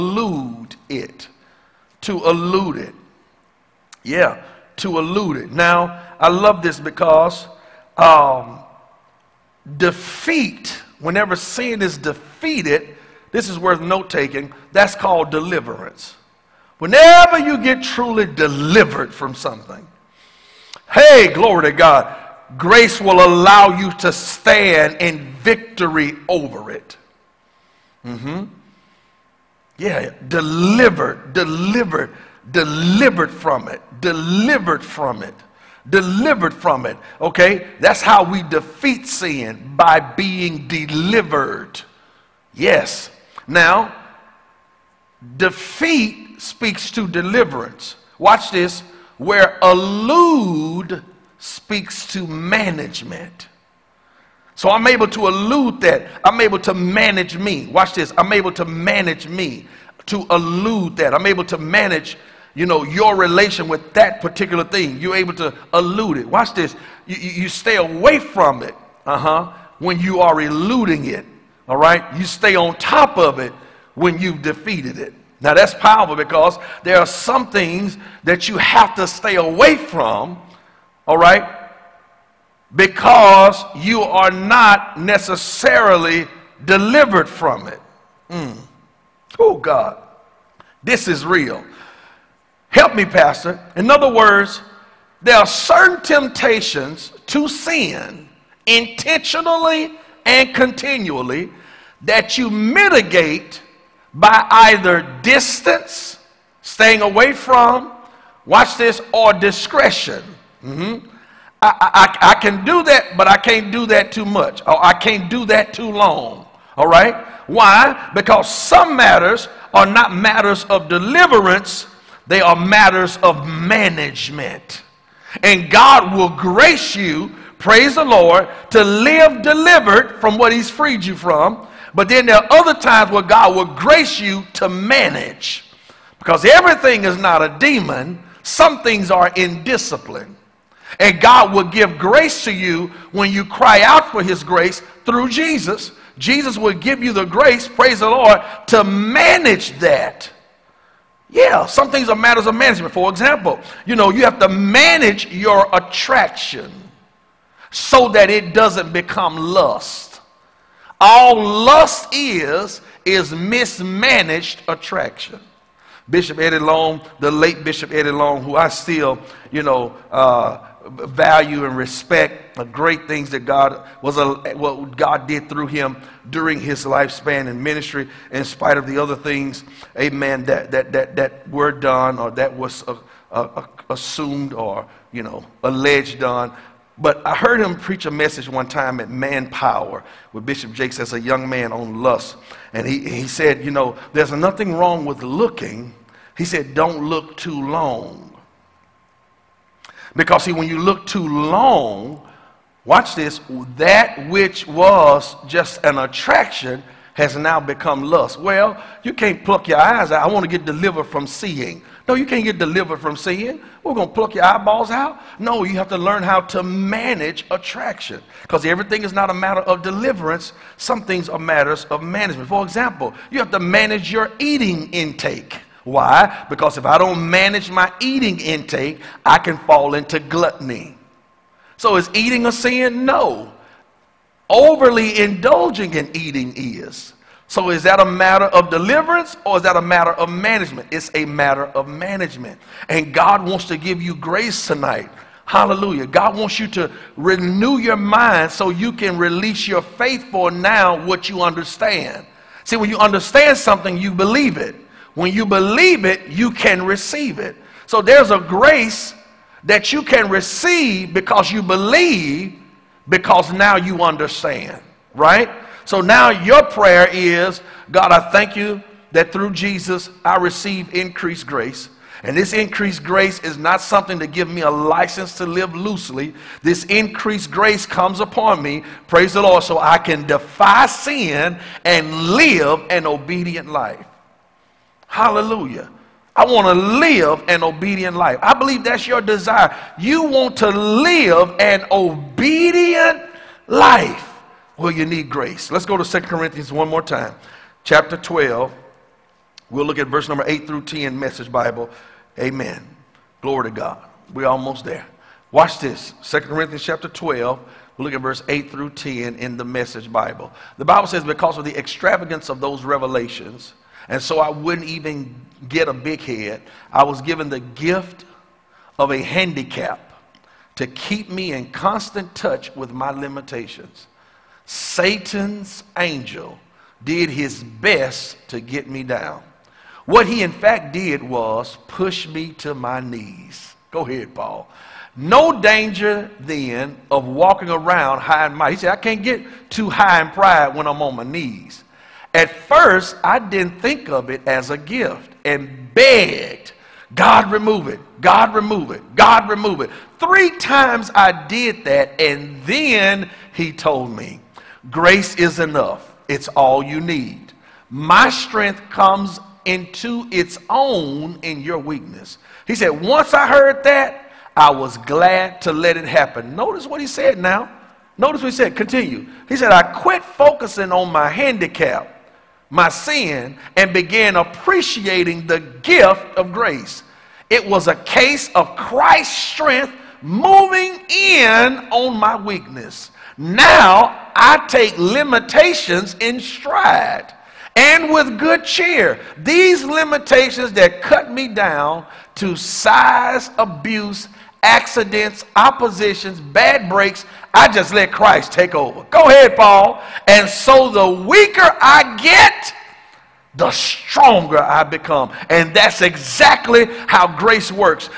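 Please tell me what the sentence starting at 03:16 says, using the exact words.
He said, Don't look too long.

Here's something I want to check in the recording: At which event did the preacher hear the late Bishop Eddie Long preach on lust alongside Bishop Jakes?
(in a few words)
Manpower.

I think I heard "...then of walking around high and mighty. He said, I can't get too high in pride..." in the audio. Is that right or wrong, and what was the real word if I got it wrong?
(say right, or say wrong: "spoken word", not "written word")
right.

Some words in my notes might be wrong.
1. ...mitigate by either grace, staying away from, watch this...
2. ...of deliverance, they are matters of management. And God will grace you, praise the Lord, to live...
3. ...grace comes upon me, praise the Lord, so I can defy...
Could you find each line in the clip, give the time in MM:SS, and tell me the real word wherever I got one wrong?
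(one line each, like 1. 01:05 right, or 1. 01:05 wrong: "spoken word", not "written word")
1. 01:42 wrong: "distance", not "grace"
2. 02:00 right
3. 04:37 right.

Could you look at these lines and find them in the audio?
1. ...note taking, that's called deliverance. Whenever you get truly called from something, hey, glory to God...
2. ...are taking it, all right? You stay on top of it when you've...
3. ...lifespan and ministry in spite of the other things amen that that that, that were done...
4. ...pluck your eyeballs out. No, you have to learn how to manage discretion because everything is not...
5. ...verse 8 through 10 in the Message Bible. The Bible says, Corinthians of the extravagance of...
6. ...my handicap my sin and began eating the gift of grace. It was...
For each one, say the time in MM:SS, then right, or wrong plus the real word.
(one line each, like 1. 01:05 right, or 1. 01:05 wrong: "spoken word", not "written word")
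1. 00:13 wrong: "delivered", not "called"
2. 01:10 wrong: "eluding", not "taking"
3. 02:56 right
4. 03:34 wrong: "attraction", not "discretion"
5. 05:08 wrong: "Because", not "Corinthians"
6. 06:11 wrong: "appreciating", not "eating".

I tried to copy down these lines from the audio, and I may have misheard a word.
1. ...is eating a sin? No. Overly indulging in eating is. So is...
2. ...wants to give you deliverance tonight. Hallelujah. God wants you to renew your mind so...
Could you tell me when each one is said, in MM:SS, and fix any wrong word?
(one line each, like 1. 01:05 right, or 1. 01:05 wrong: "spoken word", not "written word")
1. 03:51 right
2. 04:03 wrong: "grace", not "deliverance".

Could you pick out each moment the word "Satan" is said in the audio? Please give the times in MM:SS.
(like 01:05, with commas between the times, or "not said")
05:24.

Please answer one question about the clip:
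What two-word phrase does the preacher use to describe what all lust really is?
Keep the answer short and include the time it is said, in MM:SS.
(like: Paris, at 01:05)
mismanaged attraction, at 02:43.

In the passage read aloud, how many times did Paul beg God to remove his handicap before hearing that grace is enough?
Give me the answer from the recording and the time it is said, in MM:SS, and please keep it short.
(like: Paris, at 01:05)
3, at 05:50.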